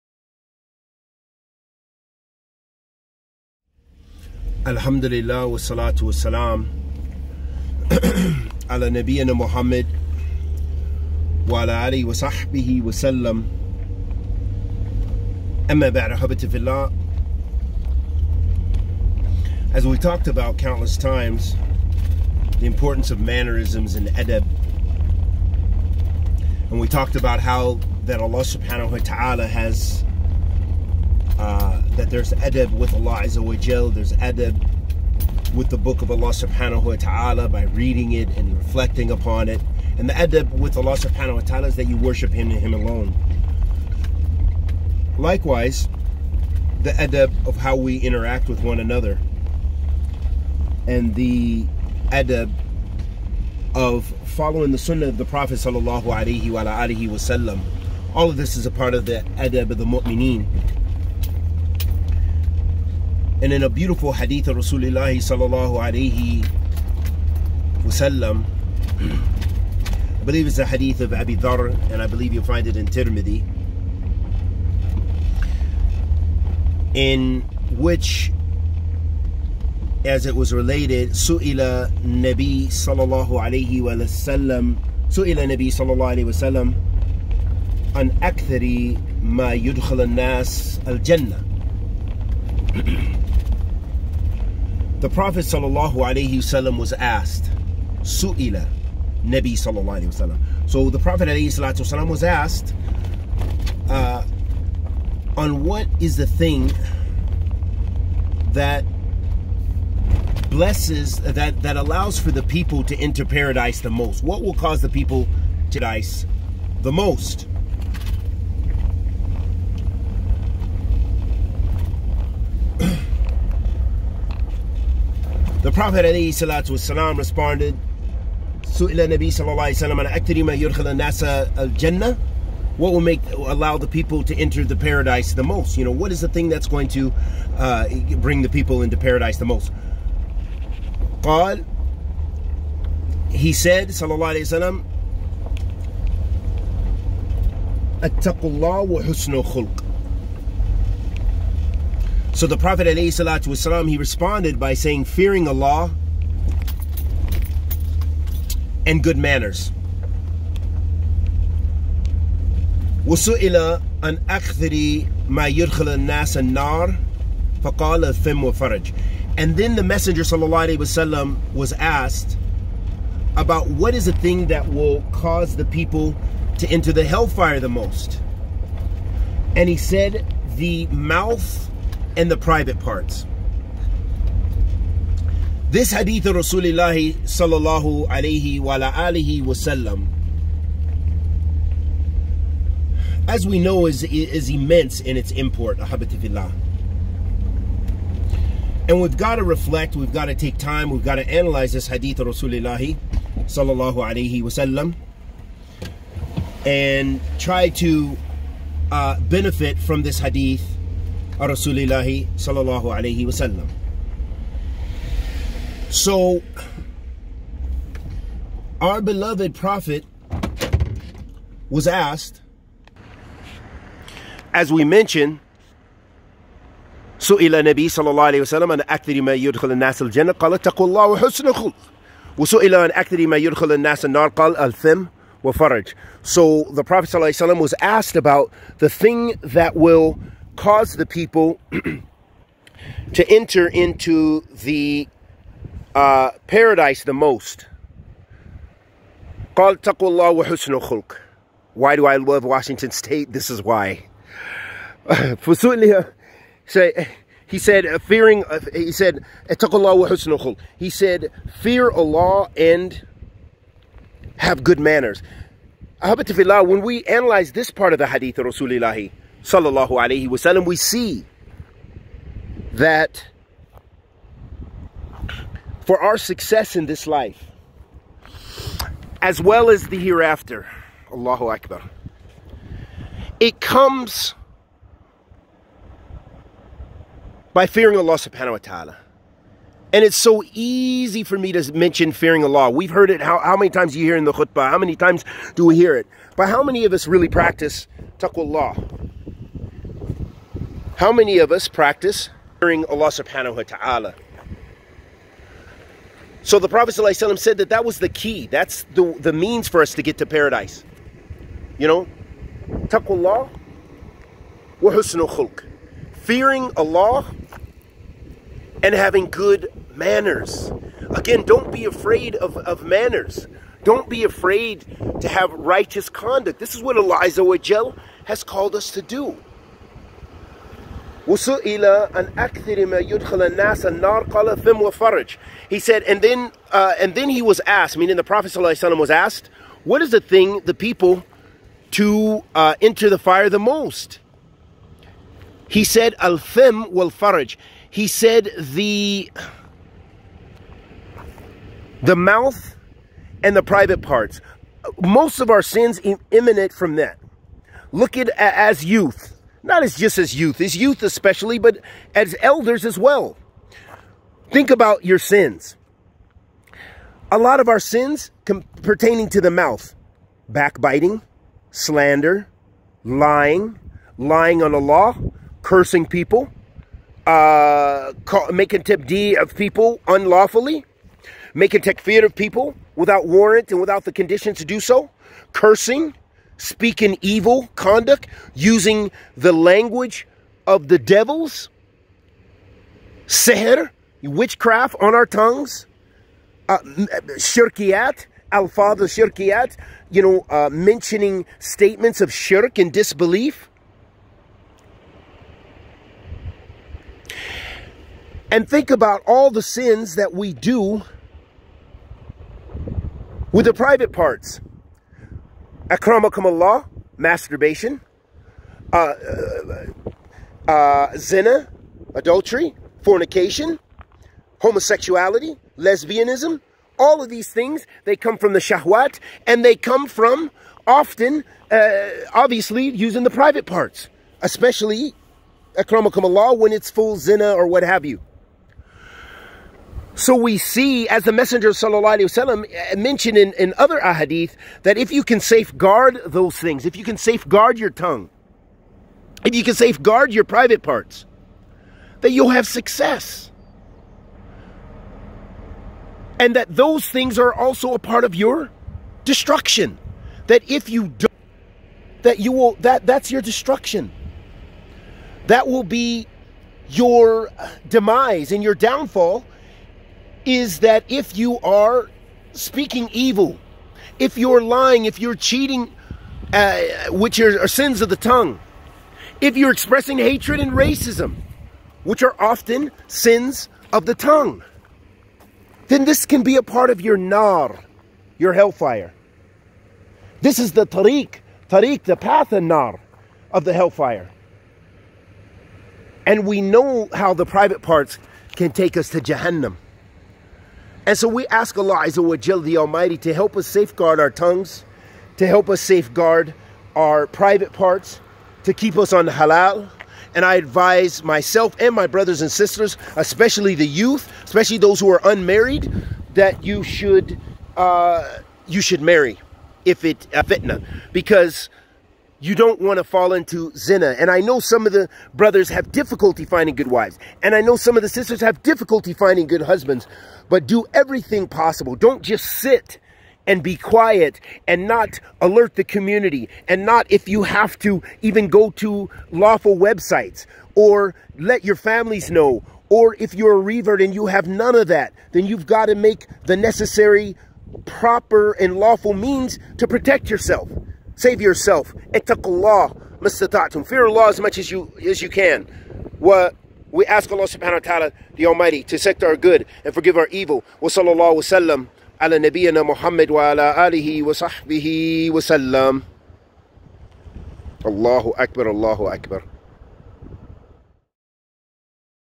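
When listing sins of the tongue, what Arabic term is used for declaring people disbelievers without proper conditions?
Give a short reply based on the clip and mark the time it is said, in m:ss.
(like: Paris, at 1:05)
takfeer, at 6:21.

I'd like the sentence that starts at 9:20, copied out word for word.
Wa sallallahu wasallam ala nabiyyina Muhammad wa ala alihi wa sahbihi wa sallam.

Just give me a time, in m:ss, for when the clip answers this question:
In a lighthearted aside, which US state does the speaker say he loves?
4:12.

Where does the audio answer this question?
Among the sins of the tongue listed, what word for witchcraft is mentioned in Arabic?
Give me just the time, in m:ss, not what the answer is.
6:33.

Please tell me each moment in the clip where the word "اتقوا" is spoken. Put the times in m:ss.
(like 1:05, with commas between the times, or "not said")
2:28, 3:50.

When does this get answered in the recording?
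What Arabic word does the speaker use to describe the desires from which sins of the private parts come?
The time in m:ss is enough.
7:08.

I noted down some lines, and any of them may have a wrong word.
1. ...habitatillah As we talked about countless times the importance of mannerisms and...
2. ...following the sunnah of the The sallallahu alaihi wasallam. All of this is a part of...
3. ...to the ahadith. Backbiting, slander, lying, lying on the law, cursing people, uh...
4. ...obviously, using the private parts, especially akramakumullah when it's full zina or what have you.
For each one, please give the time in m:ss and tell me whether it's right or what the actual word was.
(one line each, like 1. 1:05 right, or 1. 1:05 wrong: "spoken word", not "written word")
1. 0:16 right
2. 0:54 wrong: "Prophet", not "The"
3. 6:09 wrong: "mouth", not "ahadith"
4. 7:12 right.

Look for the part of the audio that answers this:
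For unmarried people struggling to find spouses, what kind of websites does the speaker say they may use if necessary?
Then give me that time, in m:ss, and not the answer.
8:59.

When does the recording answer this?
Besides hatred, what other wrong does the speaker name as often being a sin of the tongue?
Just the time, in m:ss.
8:00.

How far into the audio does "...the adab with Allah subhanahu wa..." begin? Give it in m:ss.
0:40.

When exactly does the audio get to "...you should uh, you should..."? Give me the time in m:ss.
8:36.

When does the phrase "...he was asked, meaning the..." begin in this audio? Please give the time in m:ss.
5:37.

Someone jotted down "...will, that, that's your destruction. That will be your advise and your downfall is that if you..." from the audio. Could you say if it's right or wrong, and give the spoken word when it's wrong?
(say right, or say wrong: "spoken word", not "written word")
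wrong: "demise", not "advise".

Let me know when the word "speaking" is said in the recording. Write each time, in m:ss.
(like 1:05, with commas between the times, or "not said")
6:26, 7:52.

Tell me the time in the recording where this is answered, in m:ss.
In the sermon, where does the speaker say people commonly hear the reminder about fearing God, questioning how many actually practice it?
4:54.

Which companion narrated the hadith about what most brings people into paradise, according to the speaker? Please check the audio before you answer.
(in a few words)
Abi Dharr.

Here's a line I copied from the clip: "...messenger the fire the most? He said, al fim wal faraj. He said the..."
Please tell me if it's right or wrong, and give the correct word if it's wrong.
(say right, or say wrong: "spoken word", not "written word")
wrong: "enter", not "messenger".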